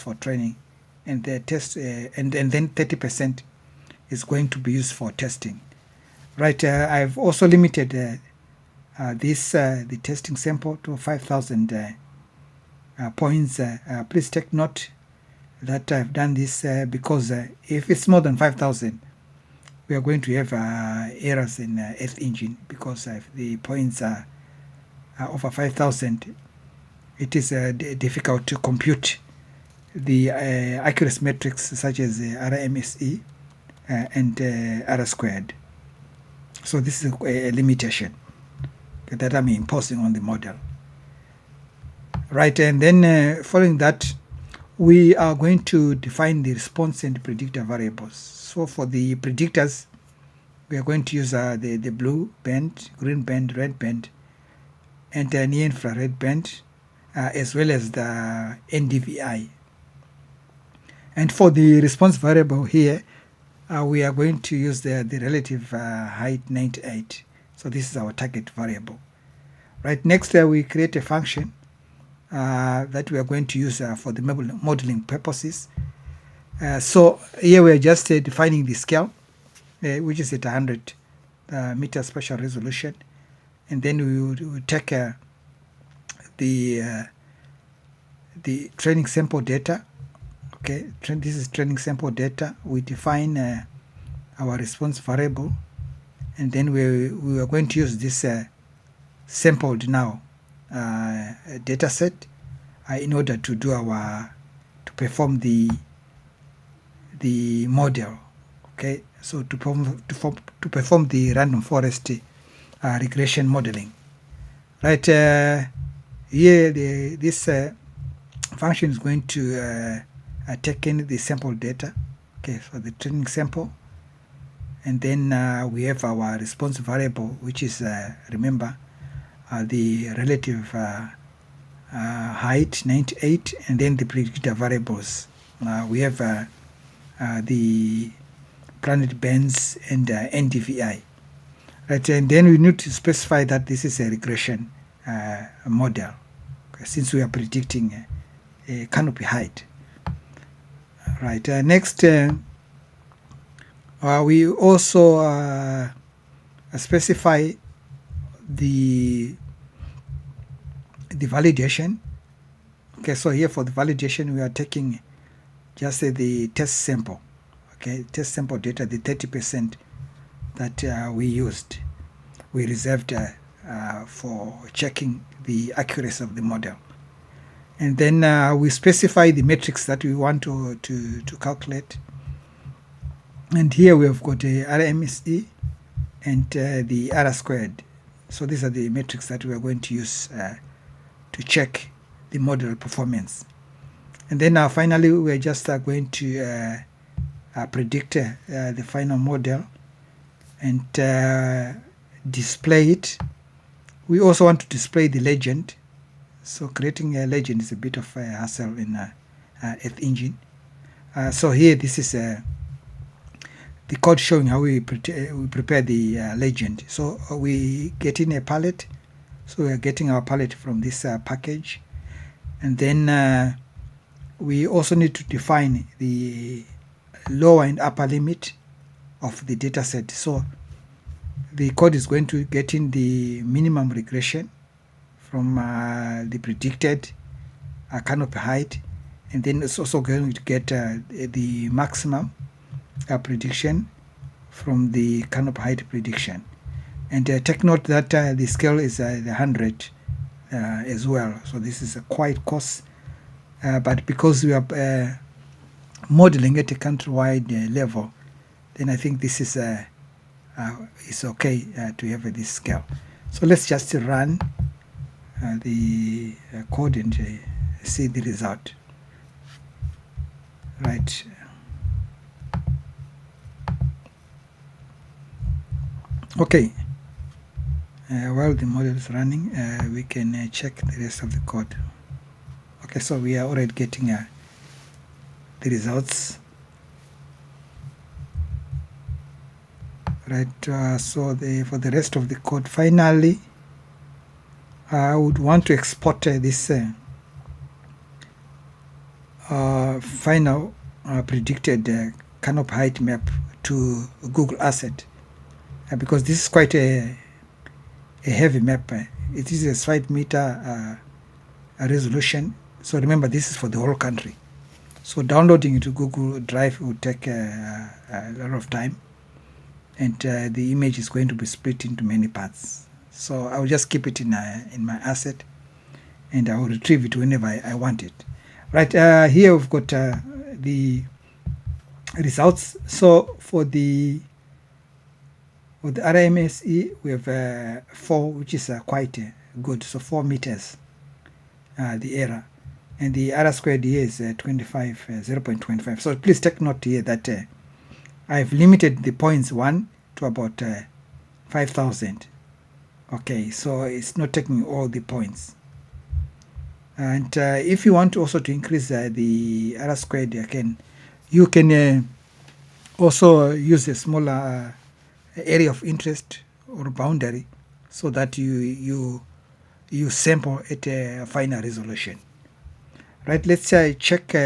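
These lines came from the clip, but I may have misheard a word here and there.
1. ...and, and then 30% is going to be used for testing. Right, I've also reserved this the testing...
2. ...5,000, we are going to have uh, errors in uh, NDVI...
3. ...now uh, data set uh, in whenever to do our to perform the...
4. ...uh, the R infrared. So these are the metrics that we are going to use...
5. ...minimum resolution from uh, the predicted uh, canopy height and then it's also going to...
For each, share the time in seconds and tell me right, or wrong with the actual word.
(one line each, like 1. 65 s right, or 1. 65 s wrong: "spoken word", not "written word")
1. 1 s wrong: "limited", not "reserved"
2. 18 s wrong: "Earth", not "NDVI"
3. 99 s wrong: "order", not "whenever"
4. 186 s wrong: "squared", not "infrared"
5. 233 s wrong: "regression", not "resolution".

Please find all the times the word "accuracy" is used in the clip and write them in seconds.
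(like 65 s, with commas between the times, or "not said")
30 s, 175 s.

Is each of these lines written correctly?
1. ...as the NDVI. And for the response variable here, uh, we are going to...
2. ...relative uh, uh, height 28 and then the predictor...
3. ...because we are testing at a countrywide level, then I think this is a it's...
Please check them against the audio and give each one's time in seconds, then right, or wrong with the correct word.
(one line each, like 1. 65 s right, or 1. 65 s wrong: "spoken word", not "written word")
1. 57 s right
2. 130 s wrong: "98", not "28"
3. 254 s wrong: "modeling", not "testing".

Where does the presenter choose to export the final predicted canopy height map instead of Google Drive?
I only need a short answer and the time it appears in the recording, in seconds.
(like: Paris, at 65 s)
Google Asset, at 304 s.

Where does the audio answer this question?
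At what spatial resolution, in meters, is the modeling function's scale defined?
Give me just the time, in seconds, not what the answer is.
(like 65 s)
80 s.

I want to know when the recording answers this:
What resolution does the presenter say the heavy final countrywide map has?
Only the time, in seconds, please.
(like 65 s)
309 s.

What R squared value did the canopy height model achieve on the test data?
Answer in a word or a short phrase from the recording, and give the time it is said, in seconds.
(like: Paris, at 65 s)
0.25, at 345 s.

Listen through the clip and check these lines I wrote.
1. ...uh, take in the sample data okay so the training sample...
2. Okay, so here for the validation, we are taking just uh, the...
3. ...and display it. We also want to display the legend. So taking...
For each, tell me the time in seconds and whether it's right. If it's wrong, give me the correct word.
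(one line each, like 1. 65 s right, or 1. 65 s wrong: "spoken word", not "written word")
1. 120 s right
2. 162 s right
3. 200 s wrong: "creating", not "taking".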